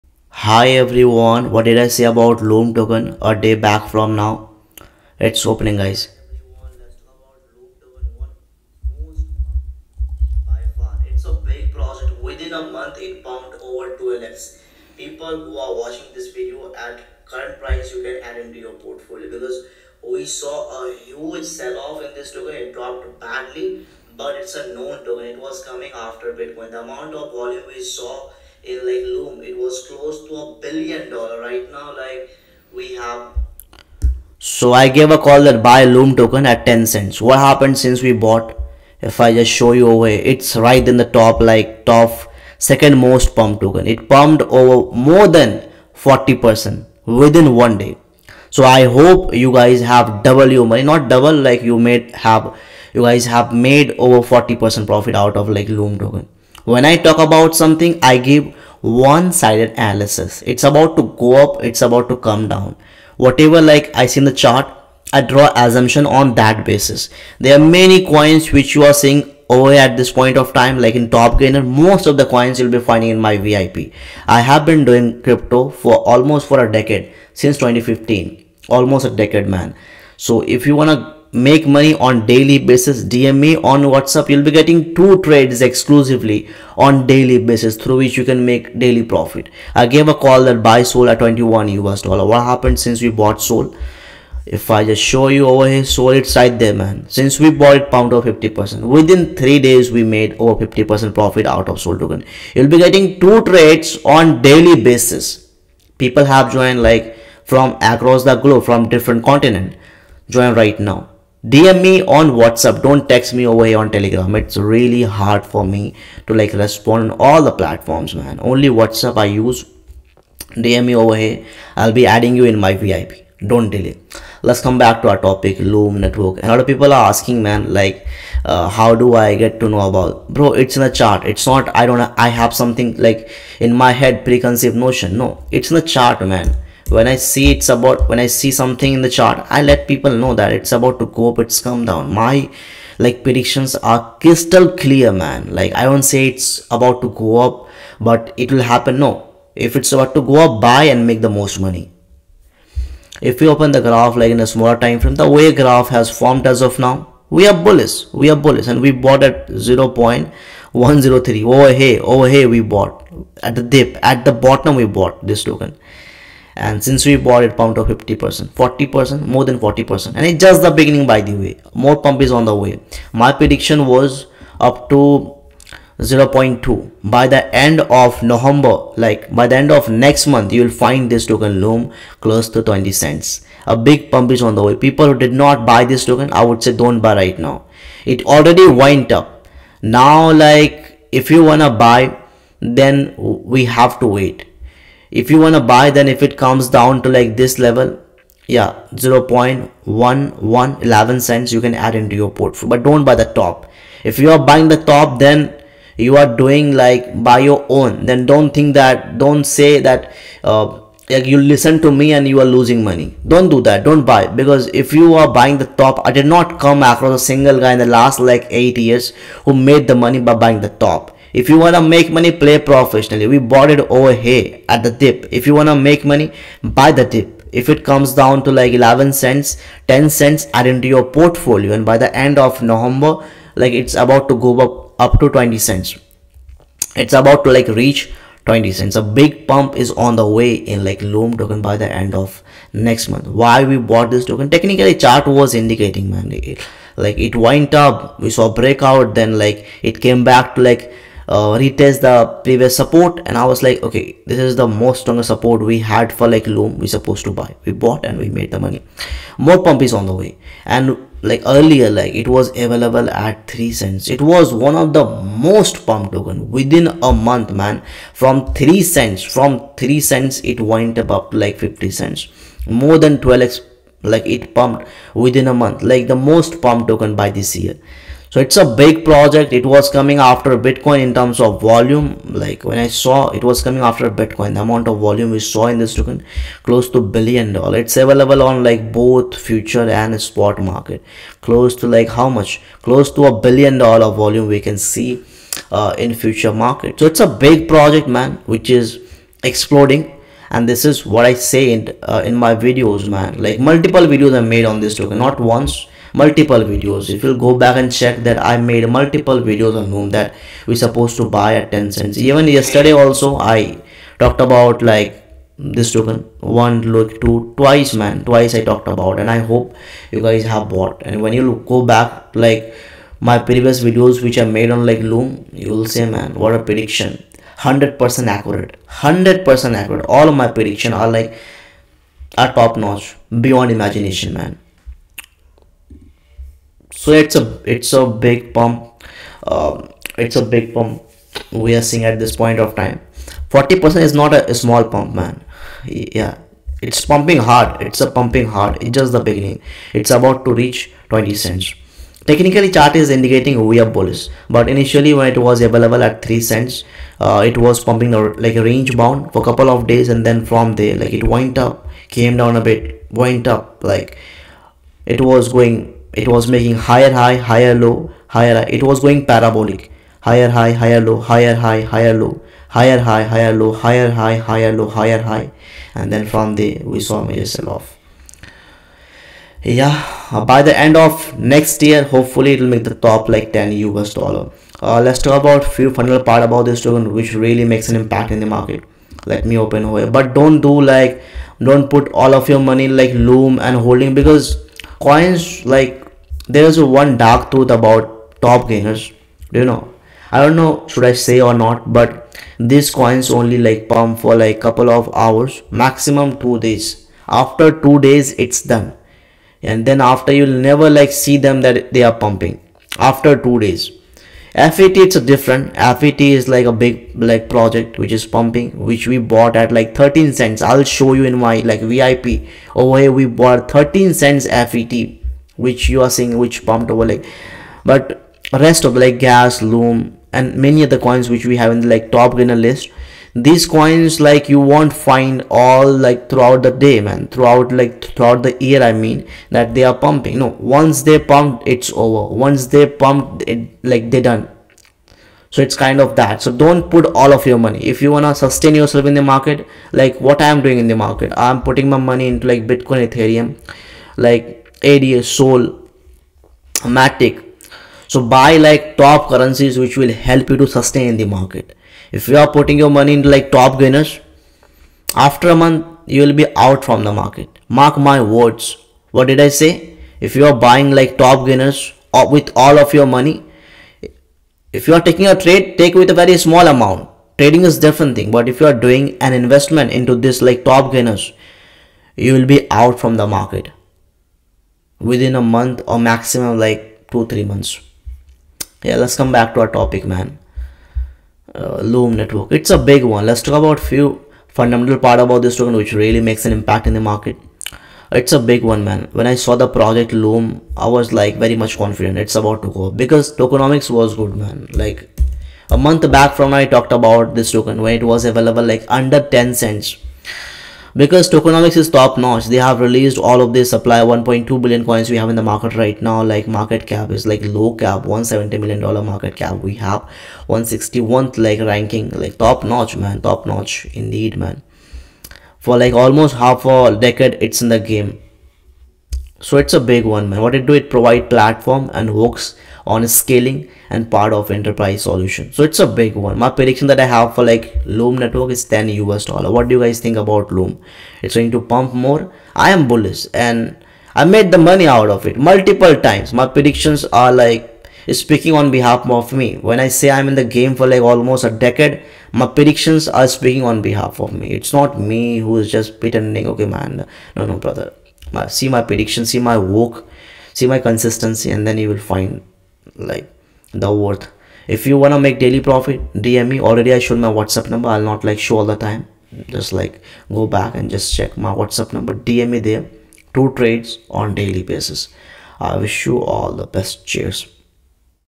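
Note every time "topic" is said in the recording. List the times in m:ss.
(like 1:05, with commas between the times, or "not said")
2:05, 8:09.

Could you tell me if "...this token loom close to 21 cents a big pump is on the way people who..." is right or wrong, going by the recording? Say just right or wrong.
wrong.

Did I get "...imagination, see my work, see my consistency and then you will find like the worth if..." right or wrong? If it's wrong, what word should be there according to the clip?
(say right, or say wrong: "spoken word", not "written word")
wrong: "prediction", not "imagination".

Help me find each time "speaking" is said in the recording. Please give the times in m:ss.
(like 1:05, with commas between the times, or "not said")
9:08, 9:13.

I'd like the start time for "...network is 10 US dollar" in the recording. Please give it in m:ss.
8:58.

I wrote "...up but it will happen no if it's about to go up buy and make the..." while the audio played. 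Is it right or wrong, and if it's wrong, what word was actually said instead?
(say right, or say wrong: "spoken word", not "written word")
right.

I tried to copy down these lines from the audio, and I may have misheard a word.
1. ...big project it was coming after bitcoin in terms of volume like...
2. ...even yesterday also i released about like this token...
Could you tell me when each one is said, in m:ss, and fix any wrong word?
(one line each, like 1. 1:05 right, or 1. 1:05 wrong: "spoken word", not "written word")
1. 4:38 right
2. 5:12 wrong: "talked", not "released".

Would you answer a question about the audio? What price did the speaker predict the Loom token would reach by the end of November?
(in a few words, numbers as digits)
20 cents.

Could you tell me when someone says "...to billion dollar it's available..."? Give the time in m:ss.
4:46.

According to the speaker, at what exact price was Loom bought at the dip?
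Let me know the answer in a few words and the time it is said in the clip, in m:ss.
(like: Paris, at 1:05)
0.103, at 2:39.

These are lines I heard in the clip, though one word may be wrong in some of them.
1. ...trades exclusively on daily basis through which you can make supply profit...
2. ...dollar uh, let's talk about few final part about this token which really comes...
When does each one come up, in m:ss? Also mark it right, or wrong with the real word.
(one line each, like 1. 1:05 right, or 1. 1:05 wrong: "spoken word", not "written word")
1. 1:25 wrong: "daily", not "supply"
2. 6:24 wrong: "makes", not "comes".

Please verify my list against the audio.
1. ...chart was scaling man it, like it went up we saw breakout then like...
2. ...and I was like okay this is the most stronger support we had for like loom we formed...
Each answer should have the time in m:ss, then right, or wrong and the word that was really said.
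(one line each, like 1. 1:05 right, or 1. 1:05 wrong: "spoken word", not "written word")
1. 4:04 wrong: "indicating", not "scaling"
2. 4:13 wrong: "supposed", not "formed".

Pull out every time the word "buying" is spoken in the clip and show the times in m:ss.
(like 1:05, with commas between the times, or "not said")
3:24, 3:35, 3:40, 7:50.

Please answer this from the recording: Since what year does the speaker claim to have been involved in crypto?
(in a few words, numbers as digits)
2015.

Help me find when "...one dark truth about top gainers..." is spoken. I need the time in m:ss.
6:36.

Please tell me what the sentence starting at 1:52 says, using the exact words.
Don't text me over here on Telegram.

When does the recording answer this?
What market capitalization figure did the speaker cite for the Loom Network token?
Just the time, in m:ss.
8:37.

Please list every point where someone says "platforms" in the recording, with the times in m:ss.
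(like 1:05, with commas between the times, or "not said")
1:57, 8:51.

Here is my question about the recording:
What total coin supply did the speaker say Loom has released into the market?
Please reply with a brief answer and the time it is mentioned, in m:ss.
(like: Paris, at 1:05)
1.2 billion, at 8:34.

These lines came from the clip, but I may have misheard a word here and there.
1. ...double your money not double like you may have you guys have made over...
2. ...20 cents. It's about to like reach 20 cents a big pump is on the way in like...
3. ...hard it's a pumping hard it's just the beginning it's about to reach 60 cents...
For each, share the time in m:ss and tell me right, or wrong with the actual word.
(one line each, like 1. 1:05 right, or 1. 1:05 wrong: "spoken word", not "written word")
1. 0:50 right
2. 3:55 right
3. 5:47 wrong: "20", not "60".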